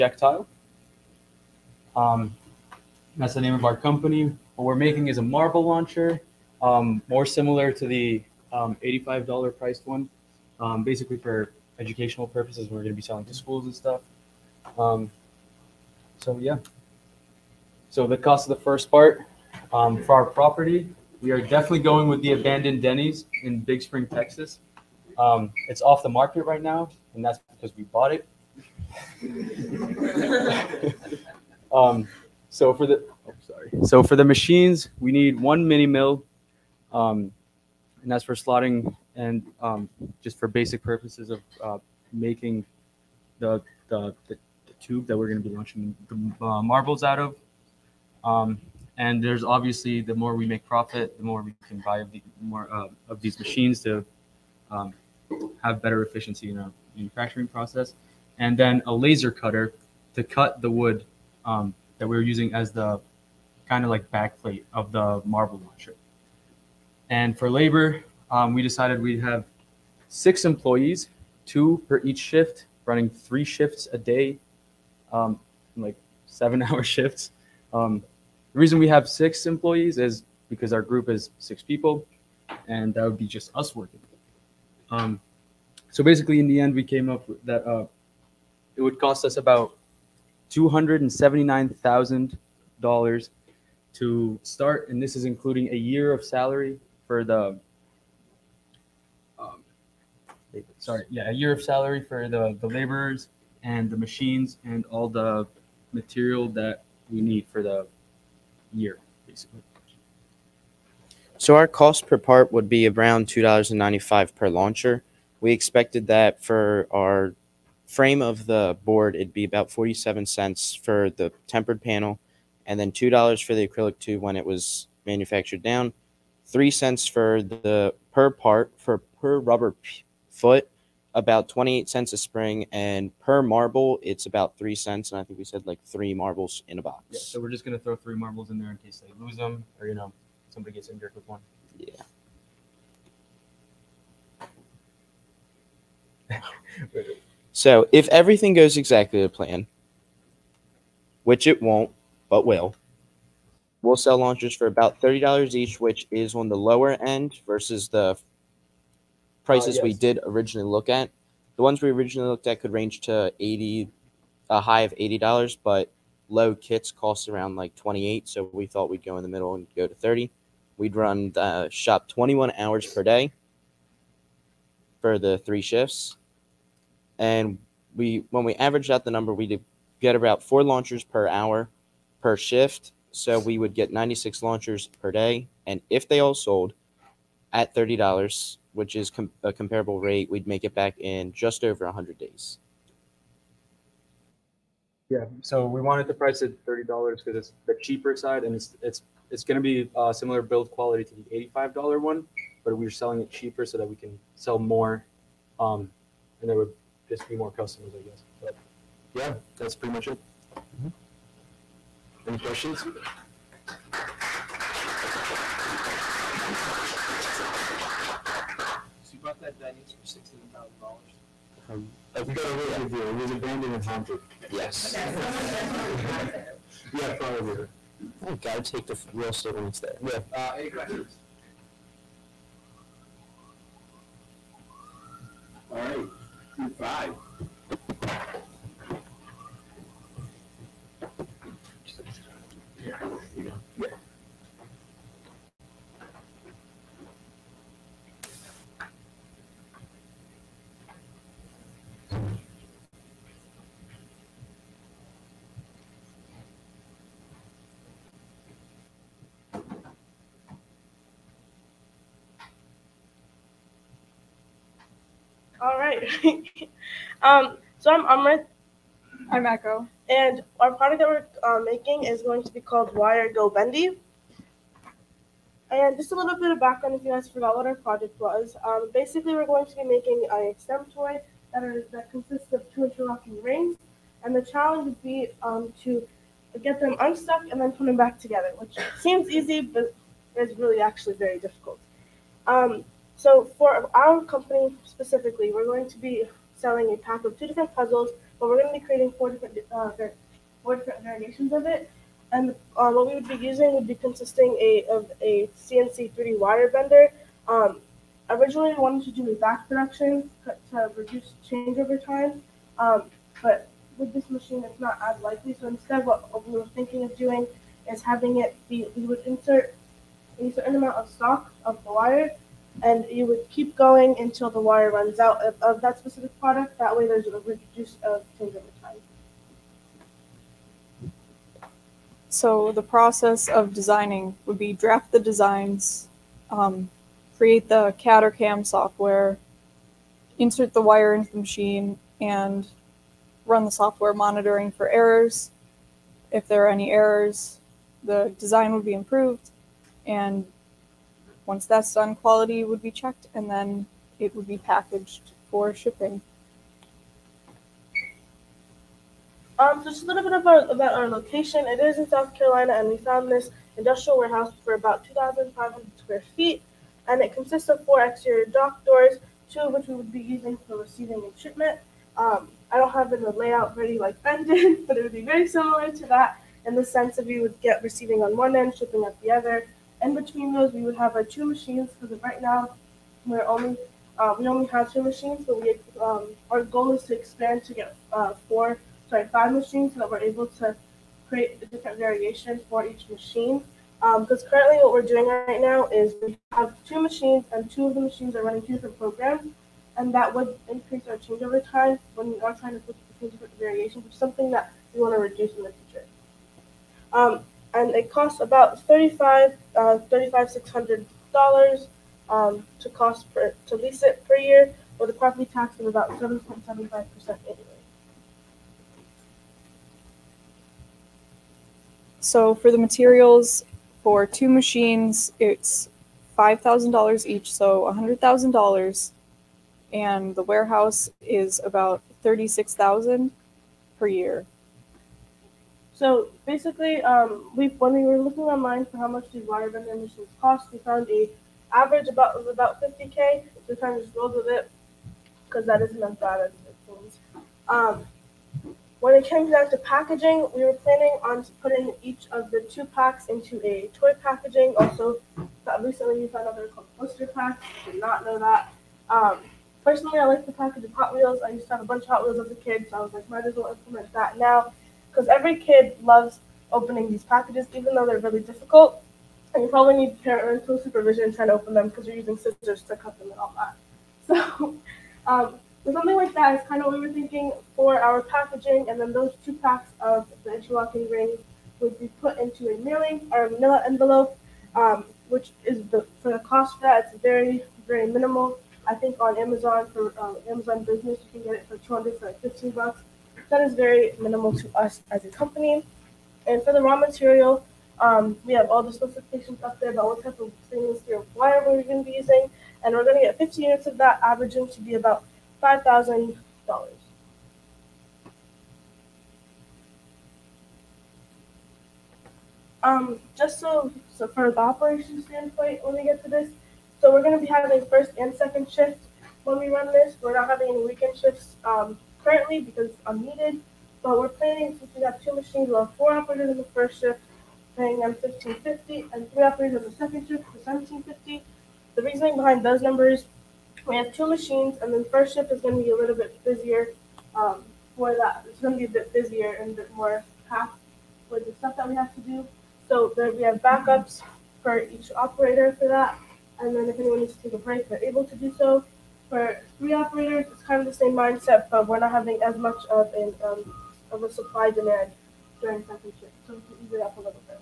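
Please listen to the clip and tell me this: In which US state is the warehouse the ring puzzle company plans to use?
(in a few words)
South Carolina.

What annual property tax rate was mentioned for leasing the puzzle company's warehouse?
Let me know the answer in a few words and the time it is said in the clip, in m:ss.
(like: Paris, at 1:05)
7.75%, at 6:56.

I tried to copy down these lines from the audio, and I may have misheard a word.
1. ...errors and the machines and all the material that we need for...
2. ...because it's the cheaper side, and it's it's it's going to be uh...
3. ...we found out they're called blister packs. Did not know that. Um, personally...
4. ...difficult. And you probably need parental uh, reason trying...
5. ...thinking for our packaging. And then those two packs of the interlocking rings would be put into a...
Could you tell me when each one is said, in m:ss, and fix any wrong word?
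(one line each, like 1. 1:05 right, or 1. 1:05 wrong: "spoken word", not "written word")
1. 1:42 wrong: "laborers", not "errors"
2. 3:17 right
3. 7:36 right
4. 7:48 wrong: "supervision", not "reason"
5. 7:57 right.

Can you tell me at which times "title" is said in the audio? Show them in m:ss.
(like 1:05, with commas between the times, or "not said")
not said.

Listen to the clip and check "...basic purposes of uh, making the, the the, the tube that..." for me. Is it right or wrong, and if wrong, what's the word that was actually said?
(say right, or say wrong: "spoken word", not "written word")
right.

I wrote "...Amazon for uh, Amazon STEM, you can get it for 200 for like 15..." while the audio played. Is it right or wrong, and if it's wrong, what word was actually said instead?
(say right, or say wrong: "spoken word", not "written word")
wrong: "Business", not "STEM".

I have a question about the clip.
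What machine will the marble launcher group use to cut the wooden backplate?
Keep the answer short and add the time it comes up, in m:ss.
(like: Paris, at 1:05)
laser cutter, at 0:58.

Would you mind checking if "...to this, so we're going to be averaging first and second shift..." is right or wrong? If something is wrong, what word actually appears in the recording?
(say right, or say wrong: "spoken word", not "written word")
wrong: "having", not "averaging".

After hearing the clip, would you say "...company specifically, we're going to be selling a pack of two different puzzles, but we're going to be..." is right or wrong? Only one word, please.
right.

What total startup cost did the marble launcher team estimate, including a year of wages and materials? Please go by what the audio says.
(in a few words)
$279,000.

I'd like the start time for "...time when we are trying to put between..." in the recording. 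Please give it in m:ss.
6:41.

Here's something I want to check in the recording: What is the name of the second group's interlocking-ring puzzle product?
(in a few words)
Wire Go Bendy.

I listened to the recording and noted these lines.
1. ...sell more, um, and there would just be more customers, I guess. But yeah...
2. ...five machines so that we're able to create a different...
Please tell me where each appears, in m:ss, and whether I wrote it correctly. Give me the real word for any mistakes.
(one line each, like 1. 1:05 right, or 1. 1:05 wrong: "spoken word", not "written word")
1. 3:24 right
2. 6:29 right.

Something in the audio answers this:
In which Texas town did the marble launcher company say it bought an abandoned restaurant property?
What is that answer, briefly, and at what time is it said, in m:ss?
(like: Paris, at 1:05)
Big Spring, at 0:23.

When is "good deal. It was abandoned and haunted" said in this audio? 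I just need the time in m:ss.
3:42.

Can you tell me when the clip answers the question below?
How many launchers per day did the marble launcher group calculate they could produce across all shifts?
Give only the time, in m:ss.
3:03.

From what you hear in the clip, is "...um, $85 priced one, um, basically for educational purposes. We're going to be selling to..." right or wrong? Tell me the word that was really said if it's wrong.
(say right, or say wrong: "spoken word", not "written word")
right.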